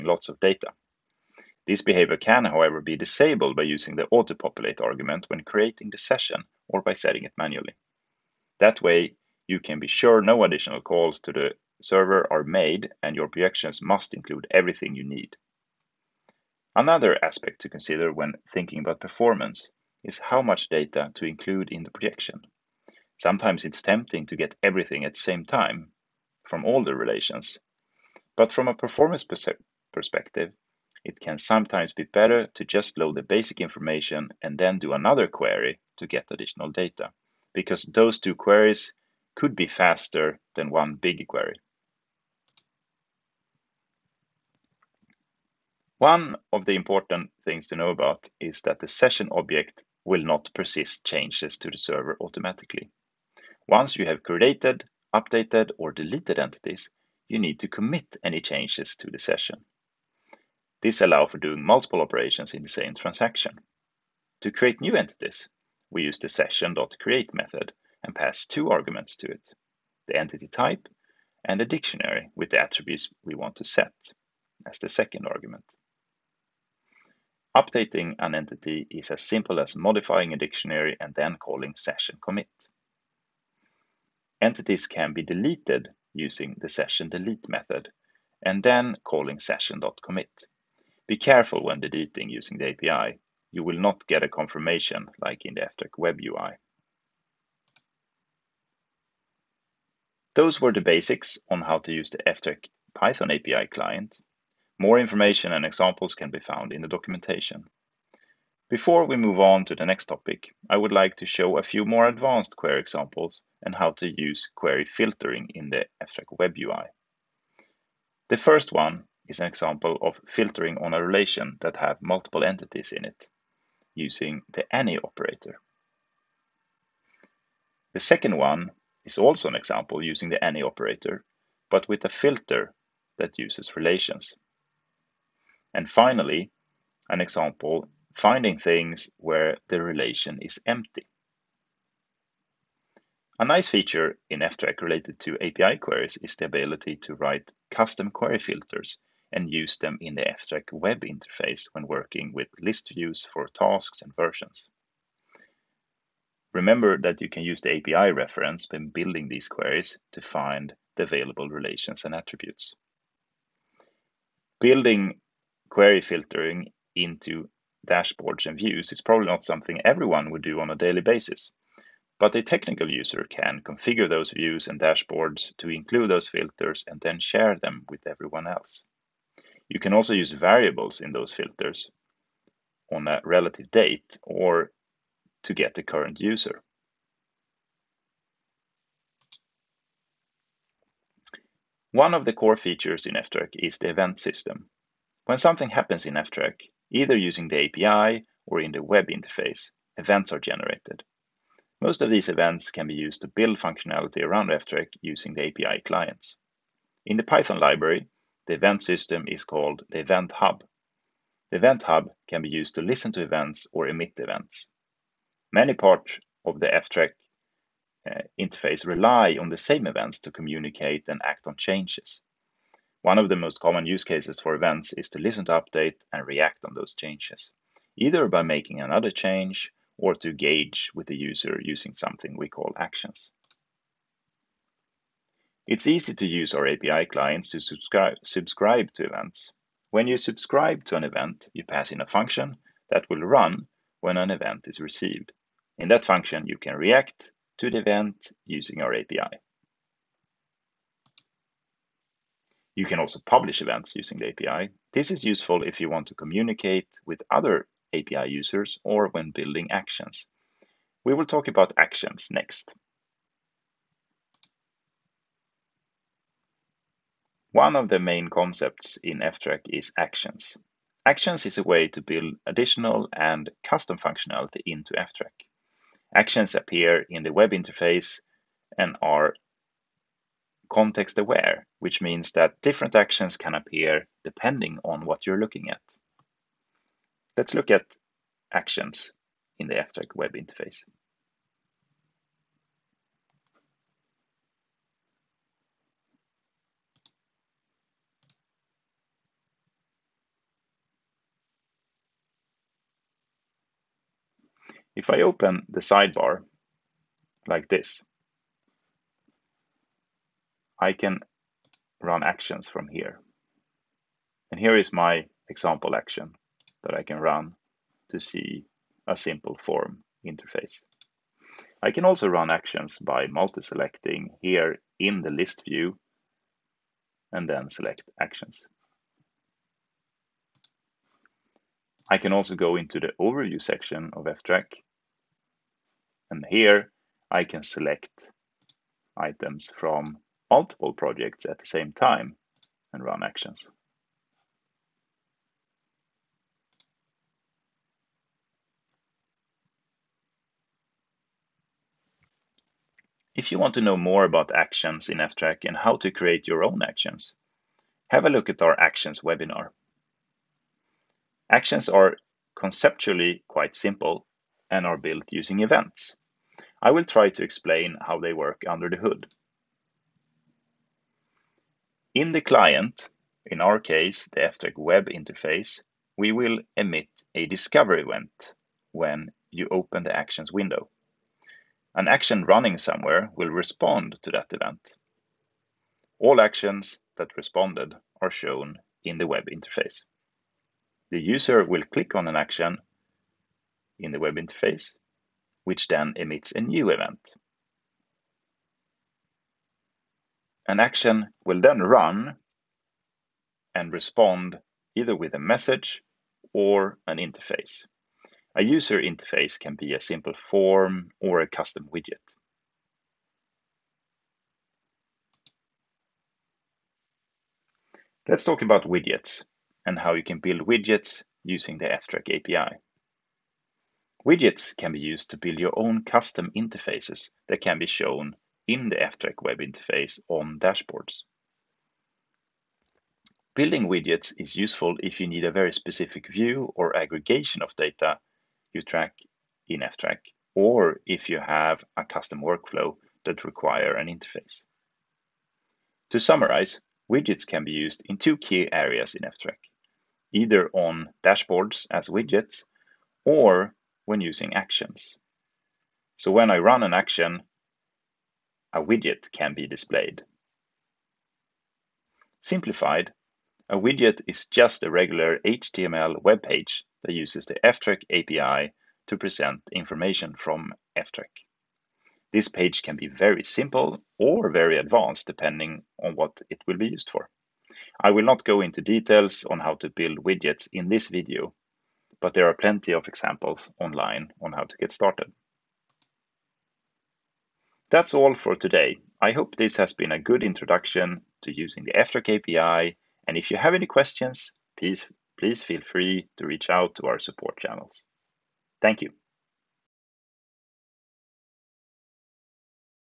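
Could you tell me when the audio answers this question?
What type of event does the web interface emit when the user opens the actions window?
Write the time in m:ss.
6:17.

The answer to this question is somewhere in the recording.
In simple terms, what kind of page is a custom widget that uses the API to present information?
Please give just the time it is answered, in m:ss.
7:45.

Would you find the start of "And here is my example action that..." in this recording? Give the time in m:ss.
5:14.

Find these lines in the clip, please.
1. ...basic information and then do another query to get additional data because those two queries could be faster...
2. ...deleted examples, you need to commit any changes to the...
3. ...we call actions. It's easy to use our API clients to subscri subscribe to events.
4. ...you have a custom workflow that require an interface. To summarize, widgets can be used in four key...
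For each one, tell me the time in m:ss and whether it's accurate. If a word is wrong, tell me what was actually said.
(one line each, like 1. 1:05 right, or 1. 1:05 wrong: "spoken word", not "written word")
1. 0:33 right
2. 0:55 wrong: "entities", not "examples"
3. 3:52 right
4. 7:21 wrong: "two", not "four".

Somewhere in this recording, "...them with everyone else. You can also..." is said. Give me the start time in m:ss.
2:57.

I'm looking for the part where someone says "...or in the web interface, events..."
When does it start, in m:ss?
3:18.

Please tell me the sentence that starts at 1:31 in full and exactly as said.
Be careful when deleting using the API you will not get a confirmation like in the ftrack web UI.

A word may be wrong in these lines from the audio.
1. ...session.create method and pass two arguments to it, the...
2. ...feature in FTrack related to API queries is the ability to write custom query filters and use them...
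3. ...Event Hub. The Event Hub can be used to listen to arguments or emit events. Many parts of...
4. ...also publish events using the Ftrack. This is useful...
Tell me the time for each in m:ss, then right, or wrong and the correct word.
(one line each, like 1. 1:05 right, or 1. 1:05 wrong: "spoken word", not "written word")
1. 1:06 right
2. 2:23 right
3. 3:30 wrong: "events", not "arguments"
4. 4:12 wrong: "API", not "Ftrack".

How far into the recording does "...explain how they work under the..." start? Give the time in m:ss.
6:07.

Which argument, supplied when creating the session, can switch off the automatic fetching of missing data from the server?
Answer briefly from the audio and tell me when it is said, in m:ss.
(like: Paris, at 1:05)
autopopulate, at 0:04.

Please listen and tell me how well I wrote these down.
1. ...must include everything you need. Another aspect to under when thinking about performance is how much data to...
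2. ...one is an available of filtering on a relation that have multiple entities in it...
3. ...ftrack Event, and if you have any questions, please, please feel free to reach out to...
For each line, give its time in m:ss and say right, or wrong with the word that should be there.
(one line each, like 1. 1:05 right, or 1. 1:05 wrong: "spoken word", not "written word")
1. 0:13 wrong: "consider", not "under"
2. 1:58 wrong: "example", not "available"
3. 8:11 wrong: "API", not "Event".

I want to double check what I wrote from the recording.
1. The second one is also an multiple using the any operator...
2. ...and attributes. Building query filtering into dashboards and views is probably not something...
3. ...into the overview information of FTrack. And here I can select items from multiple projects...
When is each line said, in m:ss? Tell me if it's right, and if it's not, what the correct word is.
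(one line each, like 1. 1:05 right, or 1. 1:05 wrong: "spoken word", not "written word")
1. 2:07 wrong: "example", not "multiple"
2. 2:42 right
3. 5:32 wrong: "section", not "information".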